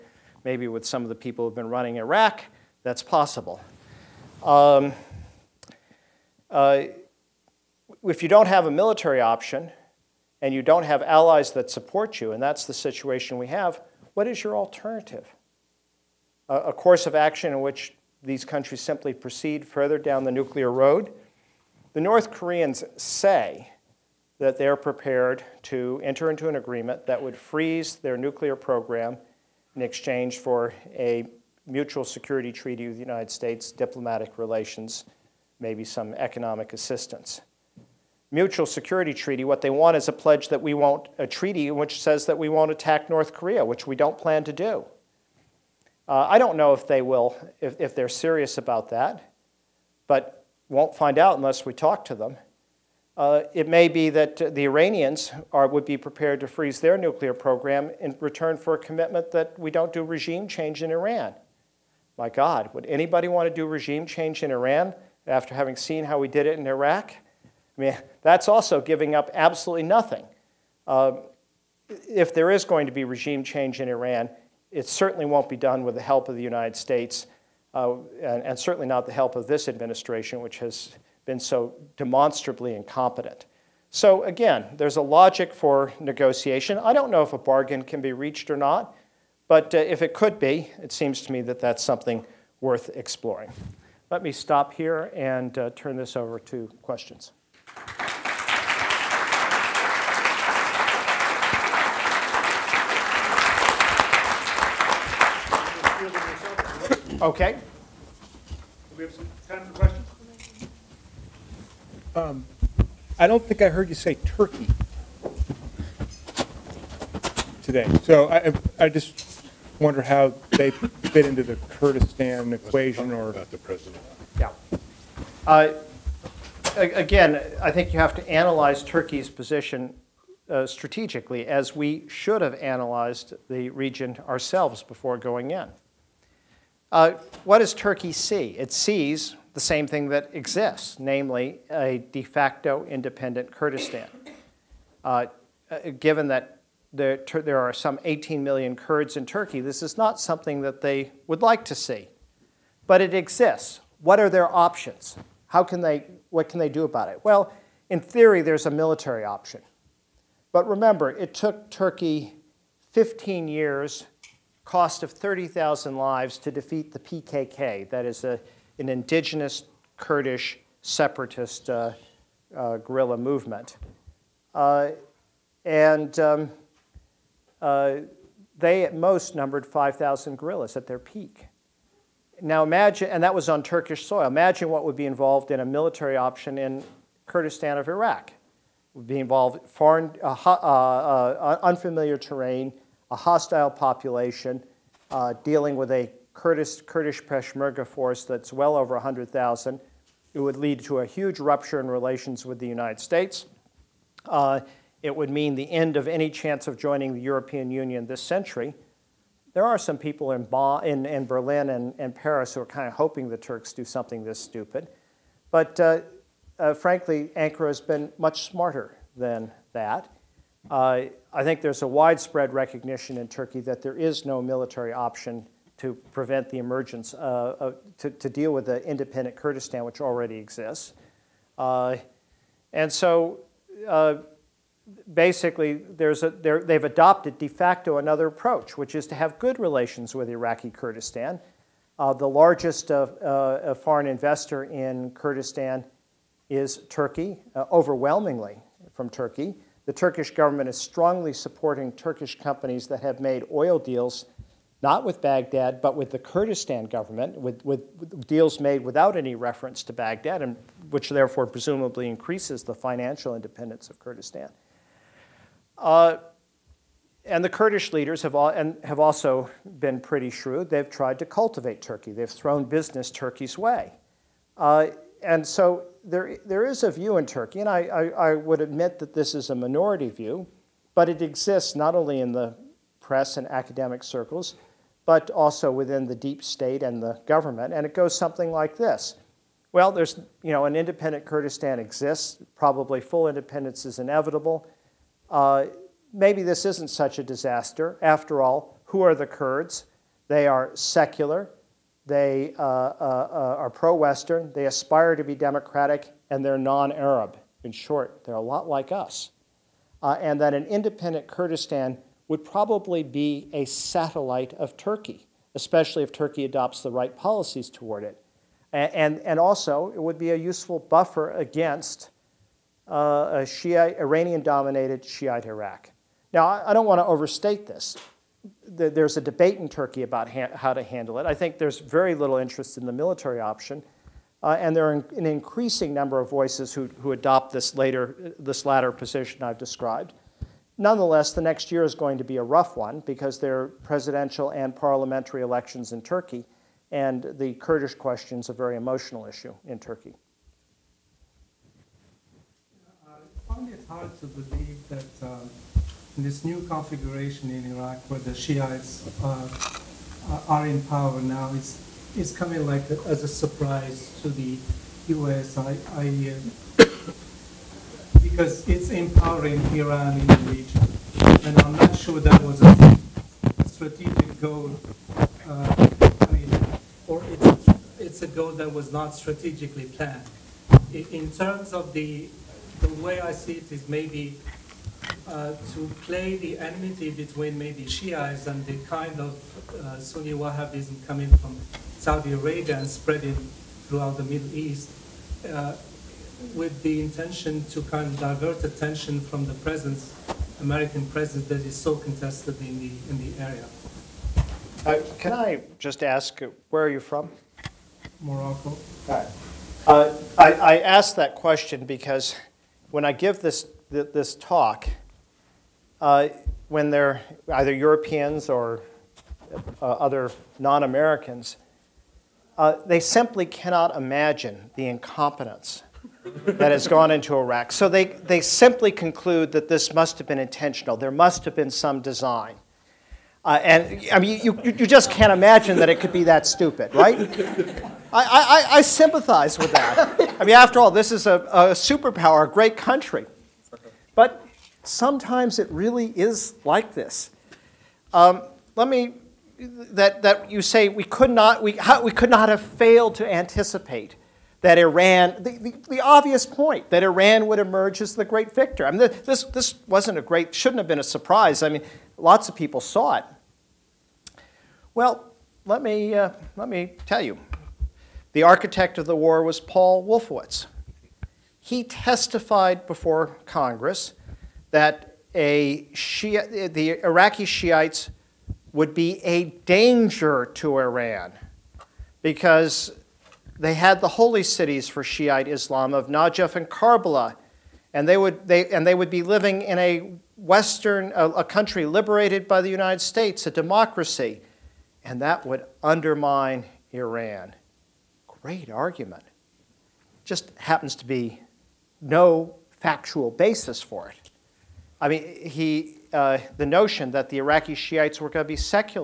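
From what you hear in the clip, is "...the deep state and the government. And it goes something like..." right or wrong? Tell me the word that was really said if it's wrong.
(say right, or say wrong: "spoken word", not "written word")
right.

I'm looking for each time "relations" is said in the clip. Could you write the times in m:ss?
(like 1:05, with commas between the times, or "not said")
0:34, 3:21, 3:59.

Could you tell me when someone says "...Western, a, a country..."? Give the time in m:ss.
8:10.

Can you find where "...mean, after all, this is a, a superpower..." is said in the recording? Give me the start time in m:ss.
7:20.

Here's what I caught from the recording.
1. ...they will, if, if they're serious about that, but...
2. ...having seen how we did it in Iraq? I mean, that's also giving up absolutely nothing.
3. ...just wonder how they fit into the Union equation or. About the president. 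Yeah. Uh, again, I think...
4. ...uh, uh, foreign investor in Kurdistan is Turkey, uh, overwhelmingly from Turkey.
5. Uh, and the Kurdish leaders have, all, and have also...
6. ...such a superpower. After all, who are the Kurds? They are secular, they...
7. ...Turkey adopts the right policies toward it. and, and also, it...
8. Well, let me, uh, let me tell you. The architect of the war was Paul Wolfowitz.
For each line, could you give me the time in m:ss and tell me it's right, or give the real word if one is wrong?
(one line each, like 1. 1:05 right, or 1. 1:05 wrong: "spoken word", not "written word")
1. 0:46 right
2. 1:05 right
3. 1:58 wrong: "Kurdistan", not "Union"
4. 4:02 right
5. 4:25 right
6. 4:56 wrong: "disaster", not "superpower"
7. 5:16 right
8. 7:44 right.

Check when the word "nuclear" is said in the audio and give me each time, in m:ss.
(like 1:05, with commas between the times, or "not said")
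0:20, 0:28, 0:56.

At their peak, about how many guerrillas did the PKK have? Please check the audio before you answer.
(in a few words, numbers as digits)
5,000.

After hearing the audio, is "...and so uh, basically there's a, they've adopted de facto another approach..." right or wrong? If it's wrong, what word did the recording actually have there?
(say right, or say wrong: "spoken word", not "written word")
right.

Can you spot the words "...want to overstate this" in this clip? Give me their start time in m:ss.
5:26.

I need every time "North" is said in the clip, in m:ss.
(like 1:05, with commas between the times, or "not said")
0:22, 0:43.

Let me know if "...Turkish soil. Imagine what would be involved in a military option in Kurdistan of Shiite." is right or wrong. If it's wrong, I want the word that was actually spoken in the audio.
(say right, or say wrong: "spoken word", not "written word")
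wrong: "Iraq", not "Shiite".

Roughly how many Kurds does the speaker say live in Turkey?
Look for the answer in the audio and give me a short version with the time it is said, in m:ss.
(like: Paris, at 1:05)
18 million, at 2:28.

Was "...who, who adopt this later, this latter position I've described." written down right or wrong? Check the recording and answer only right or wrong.
right.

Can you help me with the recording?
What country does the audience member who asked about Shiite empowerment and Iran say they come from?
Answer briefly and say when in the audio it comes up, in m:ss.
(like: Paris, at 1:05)
Morocco, at 6:48.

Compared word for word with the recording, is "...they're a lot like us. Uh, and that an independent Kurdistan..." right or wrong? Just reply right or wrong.
right.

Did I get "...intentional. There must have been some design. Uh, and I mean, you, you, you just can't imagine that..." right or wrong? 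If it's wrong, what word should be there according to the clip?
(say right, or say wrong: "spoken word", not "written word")
right.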